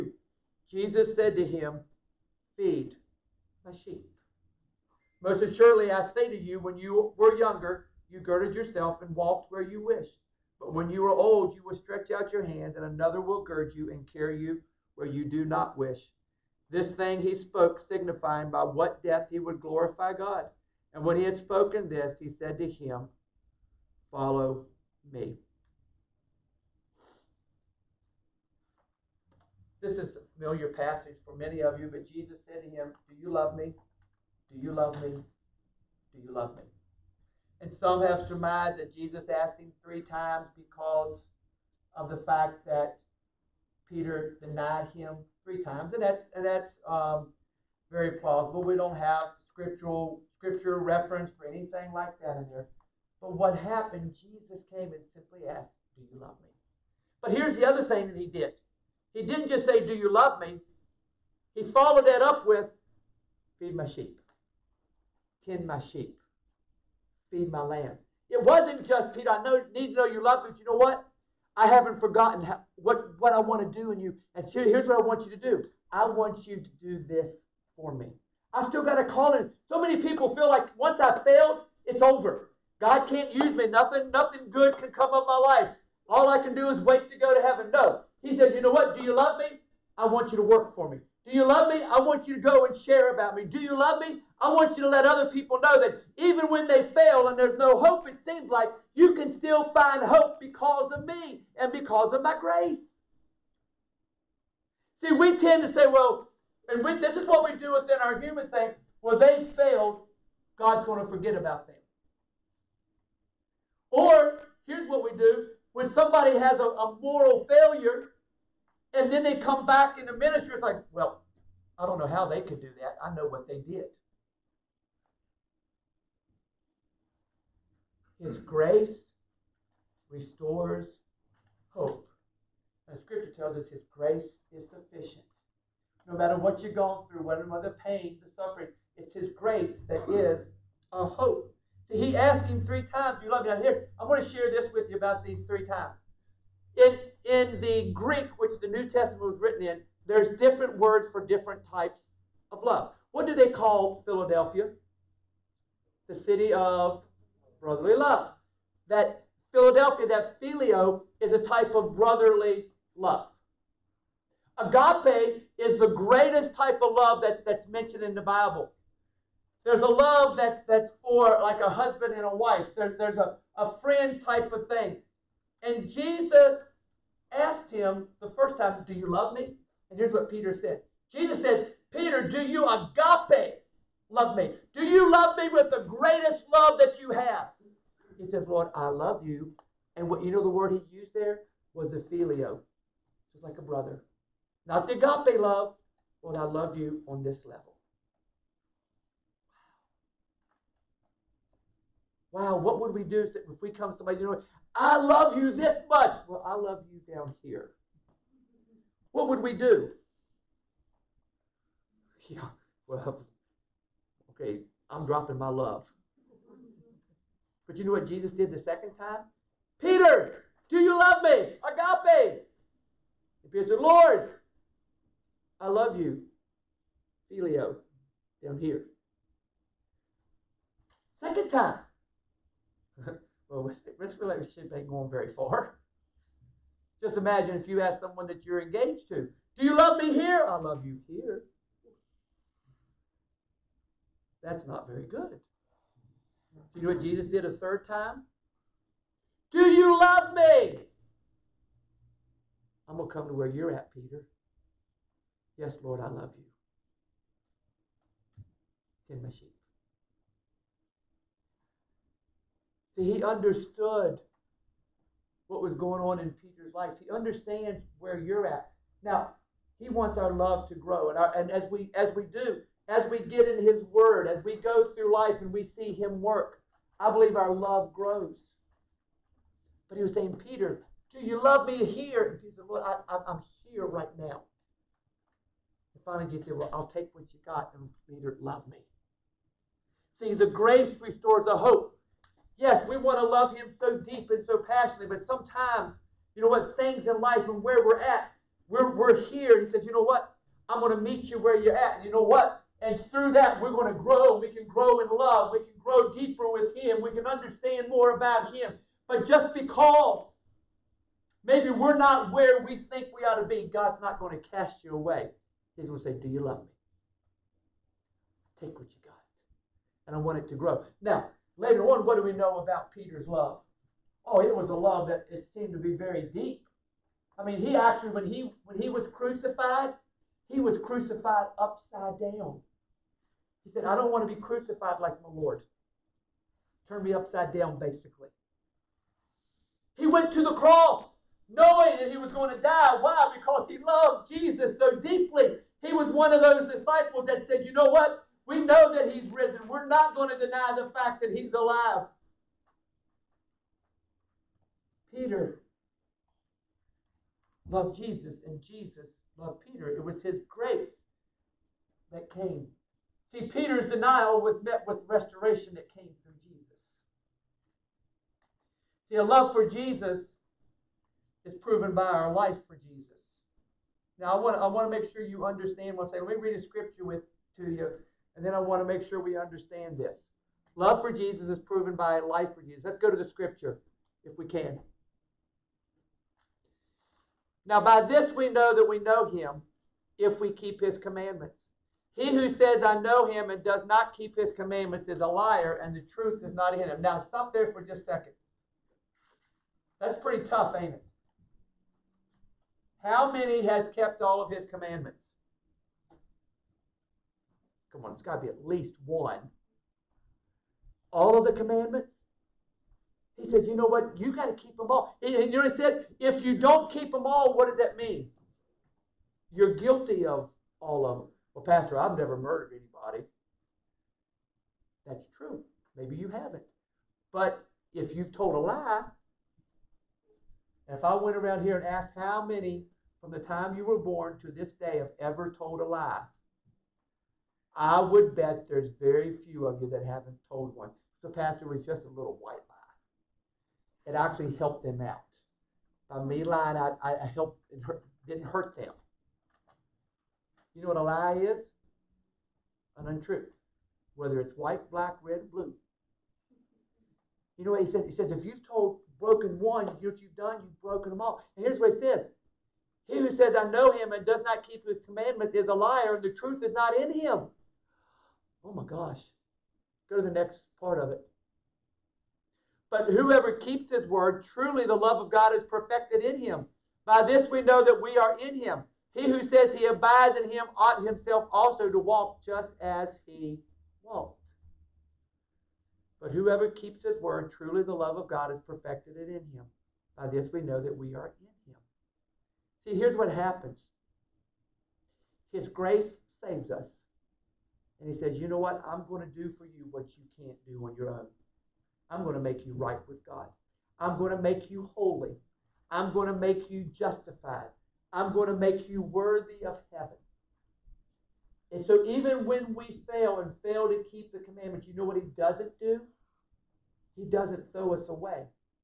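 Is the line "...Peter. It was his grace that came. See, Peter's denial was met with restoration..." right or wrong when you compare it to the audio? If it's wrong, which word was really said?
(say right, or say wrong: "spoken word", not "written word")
right.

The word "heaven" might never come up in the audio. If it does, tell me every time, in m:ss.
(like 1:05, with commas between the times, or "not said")
1:27, 8:29.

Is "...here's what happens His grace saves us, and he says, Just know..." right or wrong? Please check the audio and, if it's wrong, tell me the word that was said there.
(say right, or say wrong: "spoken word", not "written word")
wrong: "You", not "Just".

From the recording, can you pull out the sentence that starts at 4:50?
See, the grace restores the hope.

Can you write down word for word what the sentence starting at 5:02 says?
And through that, we're going to grow.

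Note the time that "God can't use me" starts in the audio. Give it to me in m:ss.
1:22.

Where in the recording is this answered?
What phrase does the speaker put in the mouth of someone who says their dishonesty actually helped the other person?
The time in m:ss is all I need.
7:21.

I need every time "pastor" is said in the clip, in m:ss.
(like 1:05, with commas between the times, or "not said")
7:01, 7:21.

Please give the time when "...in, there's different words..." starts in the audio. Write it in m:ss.
2:29.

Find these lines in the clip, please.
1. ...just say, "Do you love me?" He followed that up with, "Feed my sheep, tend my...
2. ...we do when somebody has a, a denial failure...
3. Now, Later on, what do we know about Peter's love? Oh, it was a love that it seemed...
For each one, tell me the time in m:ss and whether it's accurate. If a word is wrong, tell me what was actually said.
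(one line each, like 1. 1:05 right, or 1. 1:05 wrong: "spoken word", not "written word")
1. 0:59 right
2. 1:55 wrong: "moral", not "denial"
3. 5:21 right.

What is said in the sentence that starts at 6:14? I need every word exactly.
Now, I want to, I want to make sure you understand what I'm saying.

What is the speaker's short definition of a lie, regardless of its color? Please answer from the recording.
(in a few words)
An untruth.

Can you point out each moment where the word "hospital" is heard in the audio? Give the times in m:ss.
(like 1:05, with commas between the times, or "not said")
not said.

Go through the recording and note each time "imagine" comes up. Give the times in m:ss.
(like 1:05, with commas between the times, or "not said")
3:57.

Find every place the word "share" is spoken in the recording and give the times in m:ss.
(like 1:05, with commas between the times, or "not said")
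1:32, 2:24.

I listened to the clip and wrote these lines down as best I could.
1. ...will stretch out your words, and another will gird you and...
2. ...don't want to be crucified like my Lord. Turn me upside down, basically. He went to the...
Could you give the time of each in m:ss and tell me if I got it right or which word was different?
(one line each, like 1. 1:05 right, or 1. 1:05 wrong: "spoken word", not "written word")
1. 0:11 wrong: "hands", not "words"
2. 5:33 right.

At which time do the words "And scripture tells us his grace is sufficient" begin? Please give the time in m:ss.
2:12.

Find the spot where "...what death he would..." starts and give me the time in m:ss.
0:18.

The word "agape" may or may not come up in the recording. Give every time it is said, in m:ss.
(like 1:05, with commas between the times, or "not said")
2:44, 3:02, 3:14, 3:41.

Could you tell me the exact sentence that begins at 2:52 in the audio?
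There, there's a, a friend type of thing.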